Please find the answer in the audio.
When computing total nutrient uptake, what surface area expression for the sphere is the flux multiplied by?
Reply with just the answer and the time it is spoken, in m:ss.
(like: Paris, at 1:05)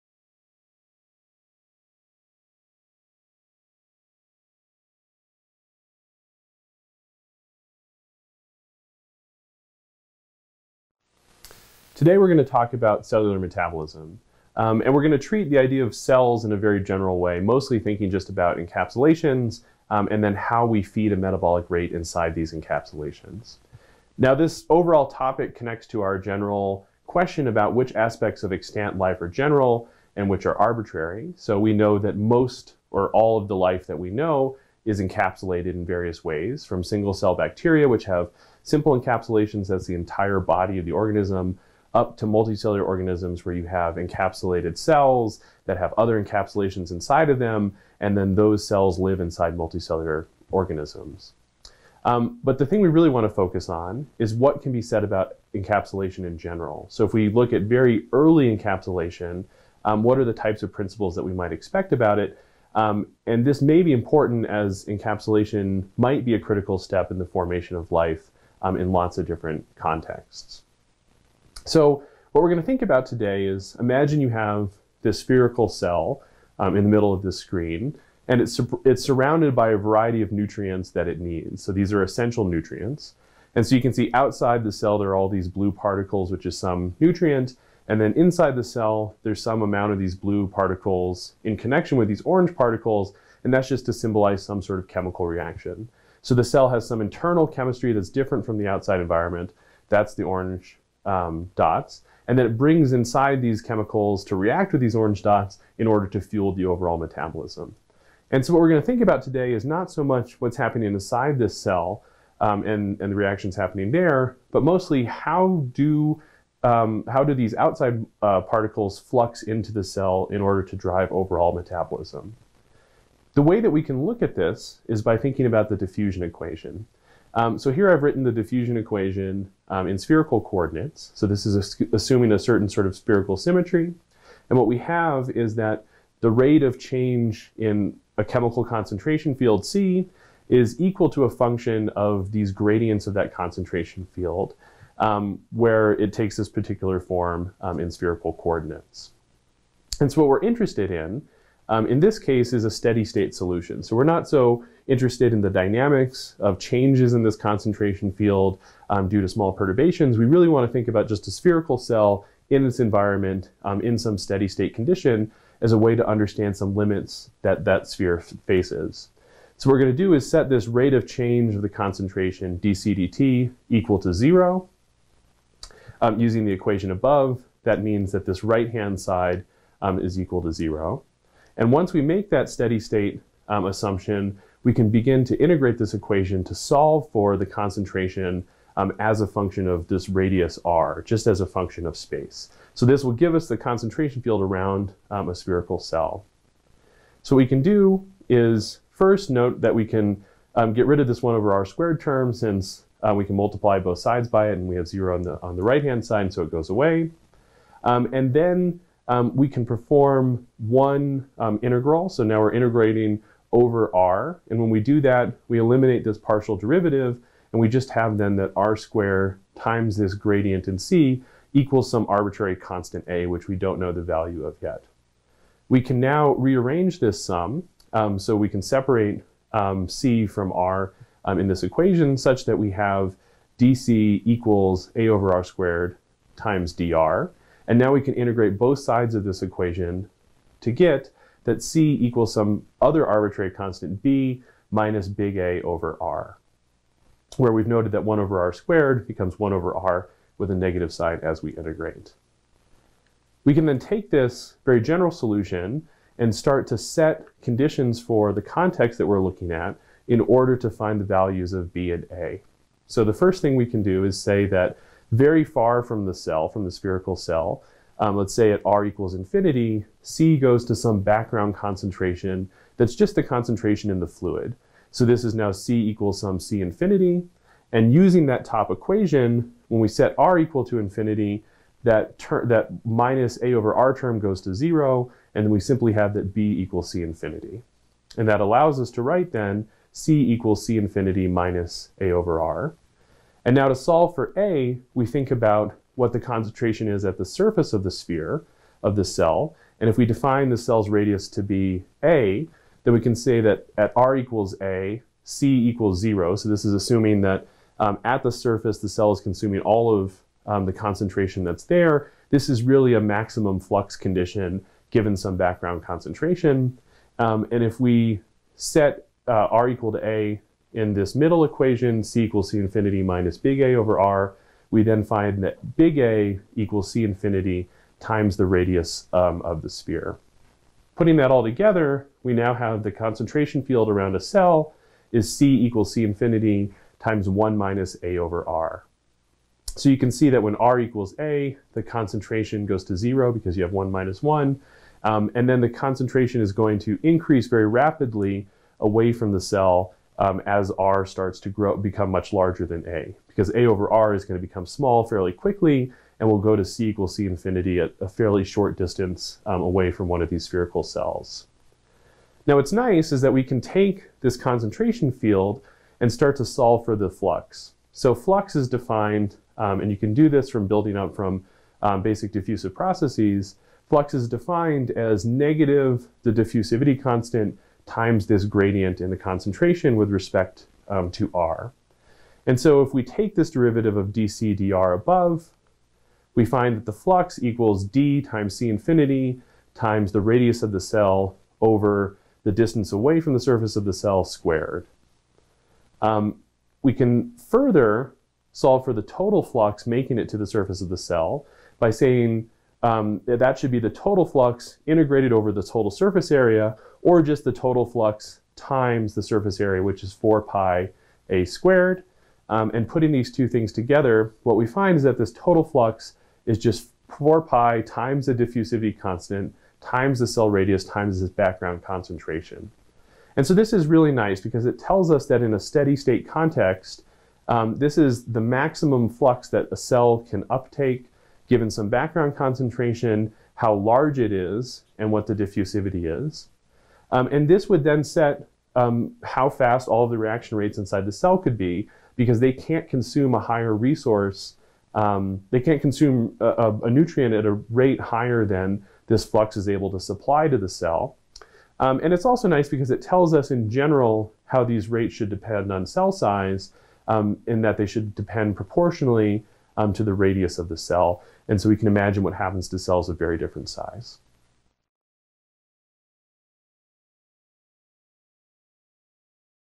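4 pi a squared, at 6:50.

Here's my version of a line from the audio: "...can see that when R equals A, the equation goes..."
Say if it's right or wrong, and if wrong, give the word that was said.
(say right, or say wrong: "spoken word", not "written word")
wrong: "concentration", not "equation".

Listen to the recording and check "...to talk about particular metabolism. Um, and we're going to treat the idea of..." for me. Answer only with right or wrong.
wrong.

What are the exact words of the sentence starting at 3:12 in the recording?
So this will give us the concentration field around um, a spherical cell.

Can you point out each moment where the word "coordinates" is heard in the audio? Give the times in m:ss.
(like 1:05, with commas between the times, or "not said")
2:10, 2:28.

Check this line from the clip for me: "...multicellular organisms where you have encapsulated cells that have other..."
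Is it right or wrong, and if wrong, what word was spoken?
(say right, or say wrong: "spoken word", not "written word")
right.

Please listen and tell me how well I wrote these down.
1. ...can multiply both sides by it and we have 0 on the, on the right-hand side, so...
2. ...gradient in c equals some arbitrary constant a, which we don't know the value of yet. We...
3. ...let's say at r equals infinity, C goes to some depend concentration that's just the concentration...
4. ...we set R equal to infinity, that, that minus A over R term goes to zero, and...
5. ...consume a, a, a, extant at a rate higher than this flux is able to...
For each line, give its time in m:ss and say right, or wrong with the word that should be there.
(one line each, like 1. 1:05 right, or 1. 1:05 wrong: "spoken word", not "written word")
1. 3:23 right
2. 3:40 right
3. 4:28 wrong: "background", not "depend"
4. 4:39 right
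5. 7:25 wrong: "nutrient", not "extant".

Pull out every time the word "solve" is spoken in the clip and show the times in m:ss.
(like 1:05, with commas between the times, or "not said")
3:06, 4:53, 6:06, 6:38.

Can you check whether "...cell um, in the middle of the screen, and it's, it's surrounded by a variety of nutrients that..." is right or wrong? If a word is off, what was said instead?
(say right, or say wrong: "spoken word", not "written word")
right.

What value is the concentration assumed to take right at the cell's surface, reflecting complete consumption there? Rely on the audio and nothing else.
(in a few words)
0.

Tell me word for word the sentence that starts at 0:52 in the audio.
Um, but the thing we really want to focus on is what can be said about encapsulation in general.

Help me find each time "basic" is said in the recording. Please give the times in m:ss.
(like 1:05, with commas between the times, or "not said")
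6:12.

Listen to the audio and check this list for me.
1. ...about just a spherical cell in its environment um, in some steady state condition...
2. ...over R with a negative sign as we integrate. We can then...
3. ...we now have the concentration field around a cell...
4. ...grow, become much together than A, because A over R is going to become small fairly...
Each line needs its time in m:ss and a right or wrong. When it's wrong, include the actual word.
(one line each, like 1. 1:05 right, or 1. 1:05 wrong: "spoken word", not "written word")
1. 2:40 right
2. 4:09 right
3. 5:32 right
4. 5:51 wrong: "larger", not "together".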